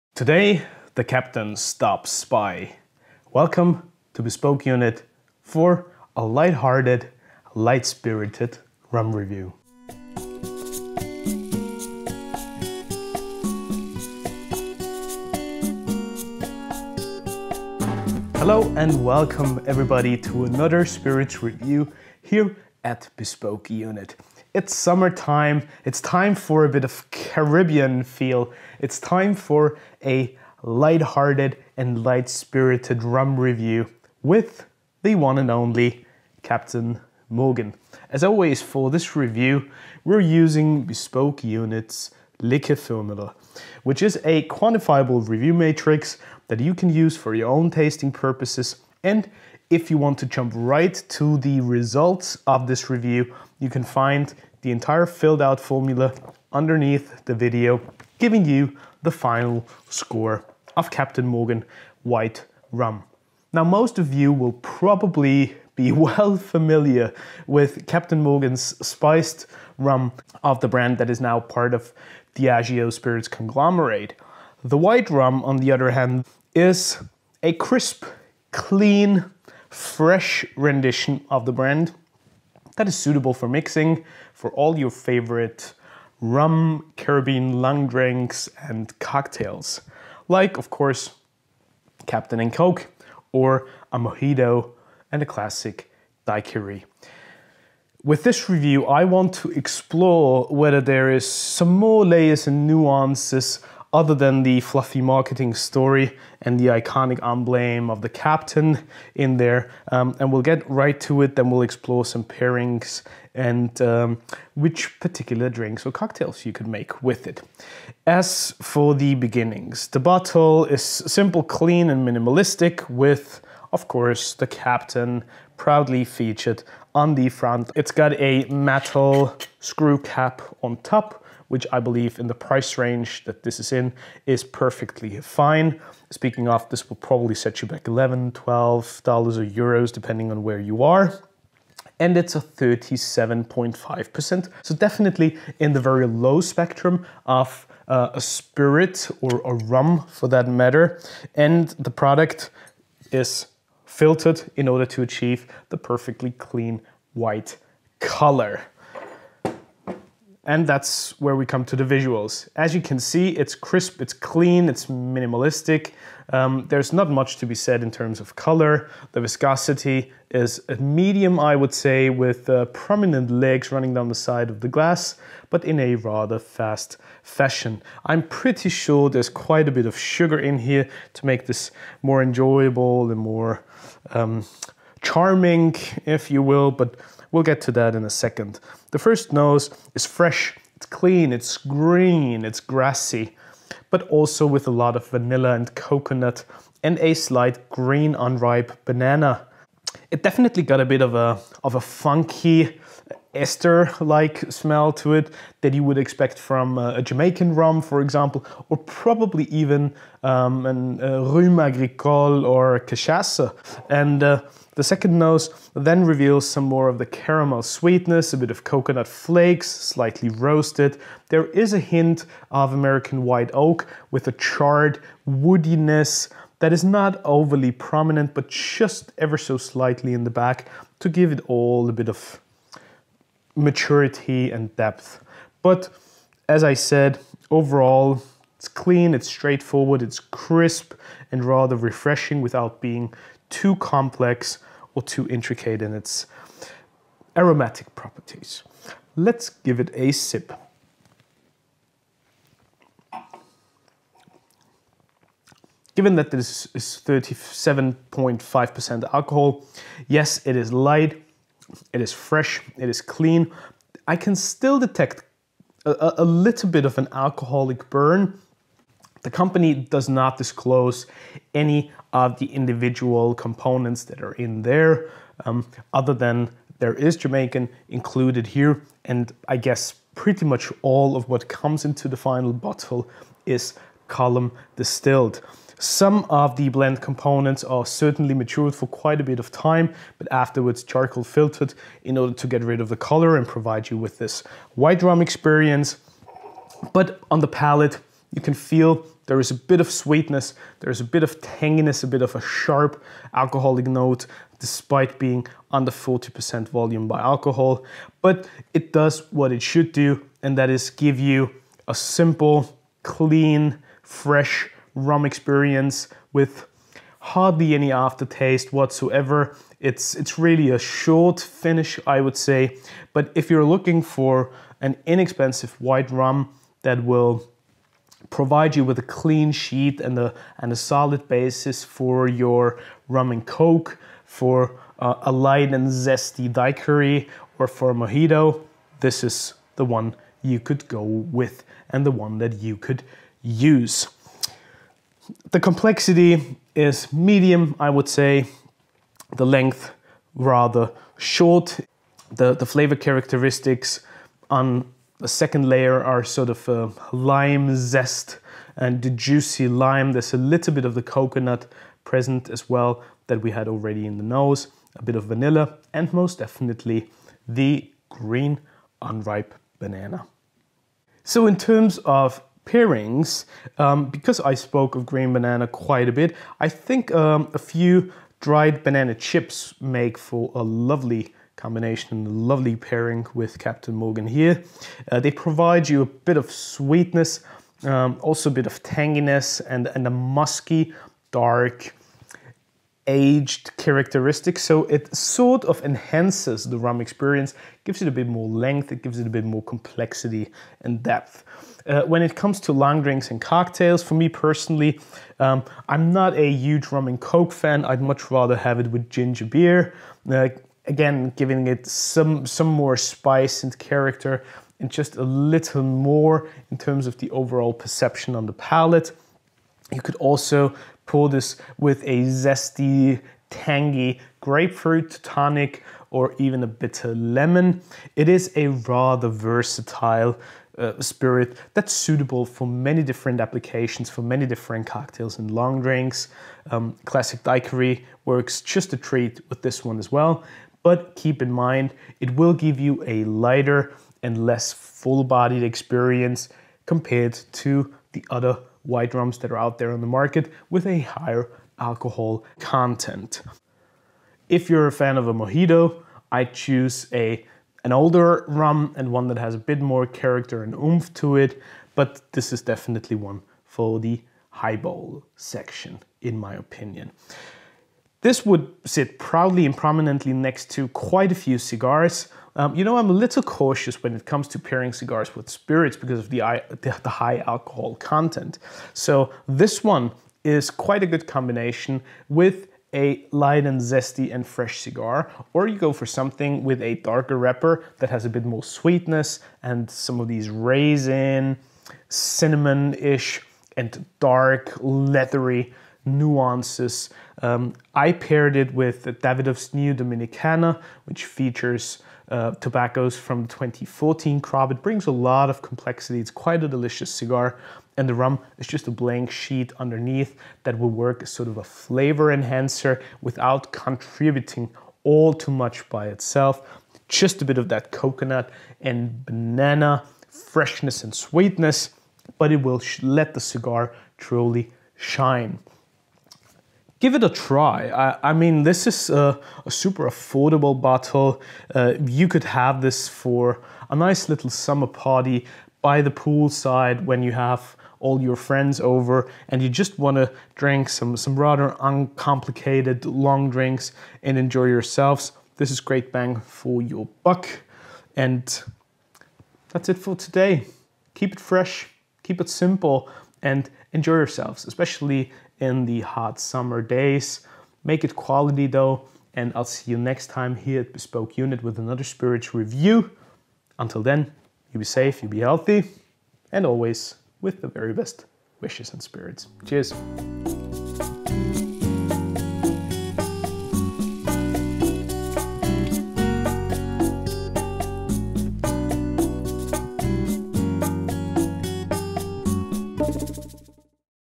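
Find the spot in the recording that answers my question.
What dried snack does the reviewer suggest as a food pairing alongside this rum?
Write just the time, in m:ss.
6:18.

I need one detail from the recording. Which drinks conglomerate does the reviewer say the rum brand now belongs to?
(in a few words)
Diageo.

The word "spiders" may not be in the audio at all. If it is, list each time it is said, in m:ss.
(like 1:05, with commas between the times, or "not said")
not said.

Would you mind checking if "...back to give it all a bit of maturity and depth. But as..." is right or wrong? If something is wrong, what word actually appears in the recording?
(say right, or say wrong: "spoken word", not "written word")
right.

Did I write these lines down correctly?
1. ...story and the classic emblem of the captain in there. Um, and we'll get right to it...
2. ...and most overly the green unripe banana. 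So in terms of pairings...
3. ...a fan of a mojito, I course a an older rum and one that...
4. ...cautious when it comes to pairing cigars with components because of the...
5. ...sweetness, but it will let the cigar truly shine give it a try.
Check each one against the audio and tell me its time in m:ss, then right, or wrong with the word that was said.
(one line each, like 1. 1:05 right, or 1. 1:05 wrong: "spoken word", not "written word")
1. 1:45 wrong: "iconic", not "classic"
2. 6:05 wrong: "definitely", not "overly"
3. 7:34 wrong: "choose", not "course"
4. 7:53 wrong: "spirits", not "components"
5. 8:41 right.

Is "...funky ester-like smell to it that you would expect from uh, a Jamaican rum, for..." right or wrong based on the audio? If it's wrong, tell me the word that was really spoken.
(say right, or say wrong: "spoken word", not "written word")
right.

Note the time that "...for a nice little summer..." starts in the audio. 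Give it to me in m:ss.
8:53.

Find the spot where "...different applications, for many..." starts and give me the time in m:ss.
7:13.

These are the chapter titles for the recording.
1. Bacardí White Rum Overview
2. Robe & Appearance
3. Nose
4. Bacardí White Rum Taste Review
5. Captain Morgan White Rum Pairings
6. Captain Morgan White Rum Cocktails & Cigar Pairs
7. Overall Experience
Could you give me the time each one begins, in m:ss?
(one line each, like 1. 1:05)
1. 1:03
2. 2:40
3. 3:09
4. 4:09
5. 6:11
6. 6:41
7. 7:46.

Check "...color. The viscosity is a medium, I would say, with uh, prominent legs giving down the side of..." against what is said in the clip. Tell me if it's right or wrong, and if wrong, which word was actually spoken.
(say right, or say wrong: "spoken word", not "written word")
wrong: "running", not "giving".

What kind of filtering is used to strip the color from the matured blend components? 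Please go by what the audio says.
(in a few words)
Charcoal filtered.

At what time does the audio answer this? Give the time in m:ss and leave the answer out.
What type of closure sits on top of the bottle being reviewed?
2:08.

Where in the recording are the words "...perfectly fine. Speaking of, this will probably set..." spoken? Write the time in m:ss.
2:14.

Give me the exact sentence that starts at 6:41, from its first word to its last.
Uh, when it comes to long drinks and cocktails, for me personally, um, I'm not a huge rum and coke fan.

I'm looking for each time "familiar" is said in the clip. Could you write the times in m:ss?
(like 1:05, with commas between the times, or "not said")
1:06.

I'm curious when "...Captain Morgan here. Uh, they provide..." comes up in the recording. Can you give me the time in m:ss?
6:23.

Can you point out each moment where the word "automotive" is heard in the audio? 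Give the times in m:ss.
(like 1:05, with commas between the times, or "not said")
not said.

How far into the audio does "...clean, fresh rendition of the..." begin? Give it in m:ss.
1:18.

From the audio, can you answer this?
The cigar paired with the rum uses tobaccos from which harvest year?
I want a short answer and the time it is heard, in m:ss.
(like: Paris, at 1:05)
2014, at 8:23.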